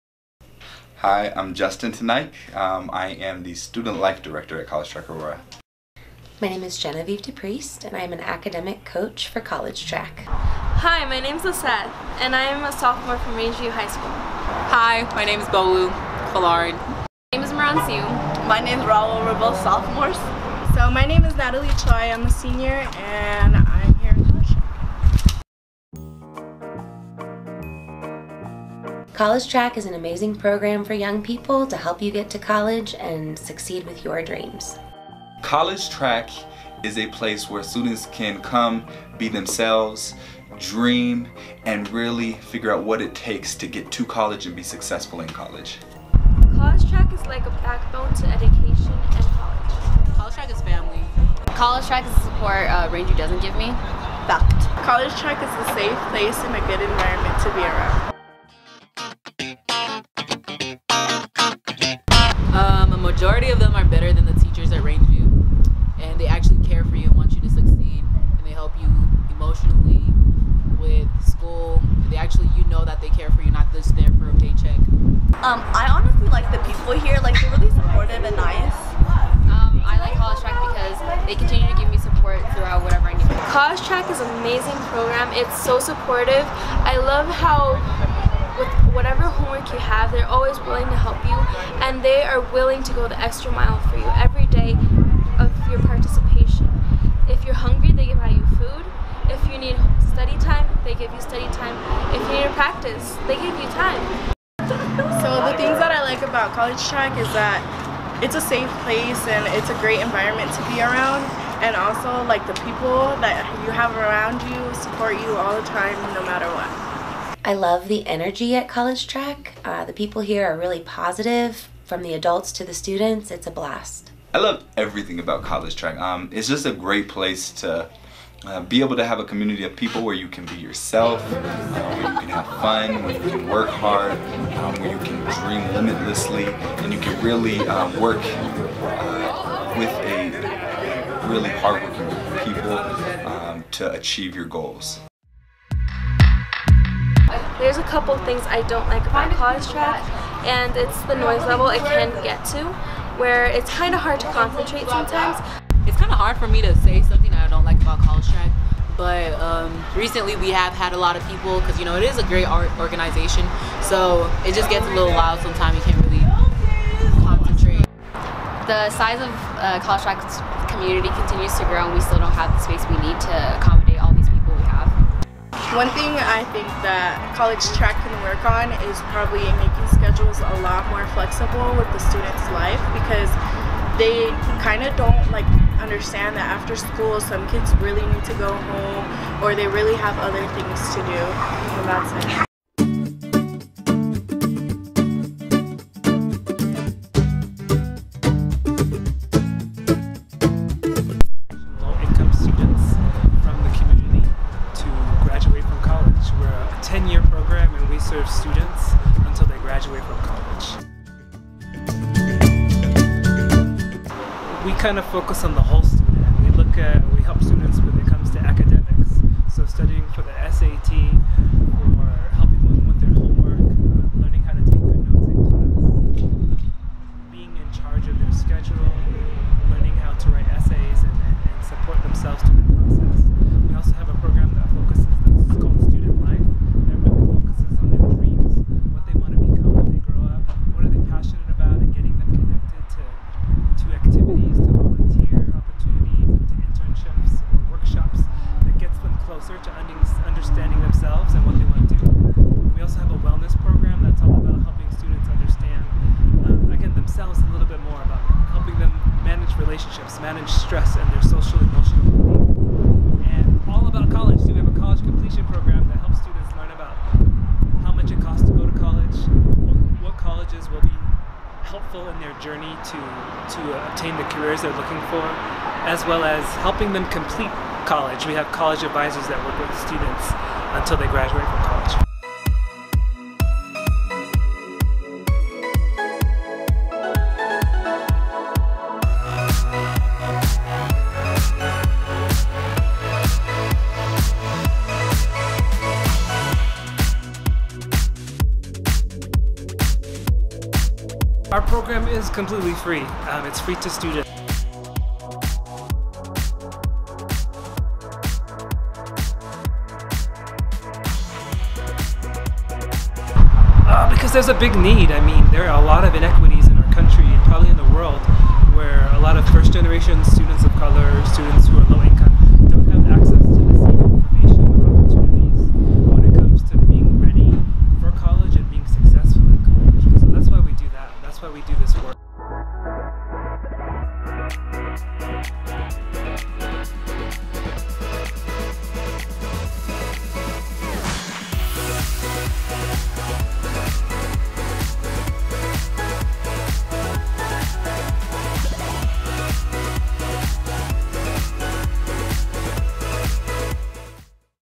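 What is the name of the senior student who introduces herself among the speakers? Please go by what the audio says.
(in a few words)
Natalie Choi.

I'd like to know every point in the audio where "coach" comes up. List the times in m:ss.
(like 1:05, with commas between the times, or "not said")
0:08.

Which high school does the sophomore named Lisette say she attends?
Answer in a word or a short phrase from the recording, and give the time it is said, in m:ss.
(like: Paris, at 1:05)
Rangeview High School, at 0:13.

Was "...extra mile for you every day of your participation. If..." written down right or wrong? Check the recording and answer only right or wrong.
right.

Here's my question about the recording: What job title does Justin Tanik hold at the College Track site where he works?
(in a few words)
Student Life Director.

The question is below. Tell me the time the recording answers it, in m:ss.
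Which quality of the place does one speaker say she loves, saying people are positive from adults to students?
1:57.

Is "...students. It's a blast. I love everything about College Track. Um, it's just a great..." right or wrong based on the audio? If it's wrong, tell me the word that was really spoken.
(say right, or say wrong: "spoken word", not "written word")
right.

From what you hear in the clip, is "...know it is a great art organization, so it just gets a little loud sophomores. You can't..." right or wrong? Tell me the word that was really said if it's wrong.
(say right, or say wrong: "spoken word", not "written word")
wrong: "sometimes", not "sophomores".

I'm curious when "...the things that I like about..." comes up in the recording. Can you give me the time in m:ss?
1:45.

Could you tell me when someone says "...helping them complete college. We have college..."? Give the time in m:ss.
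4:36.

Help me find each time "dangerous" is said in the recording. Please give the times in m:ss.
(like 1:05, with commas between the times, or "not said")
not said.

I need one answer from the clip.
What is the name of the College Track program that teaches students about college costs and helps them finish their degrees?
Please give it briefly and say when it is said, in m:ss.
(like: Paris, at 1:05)
college completion program, at 4:24.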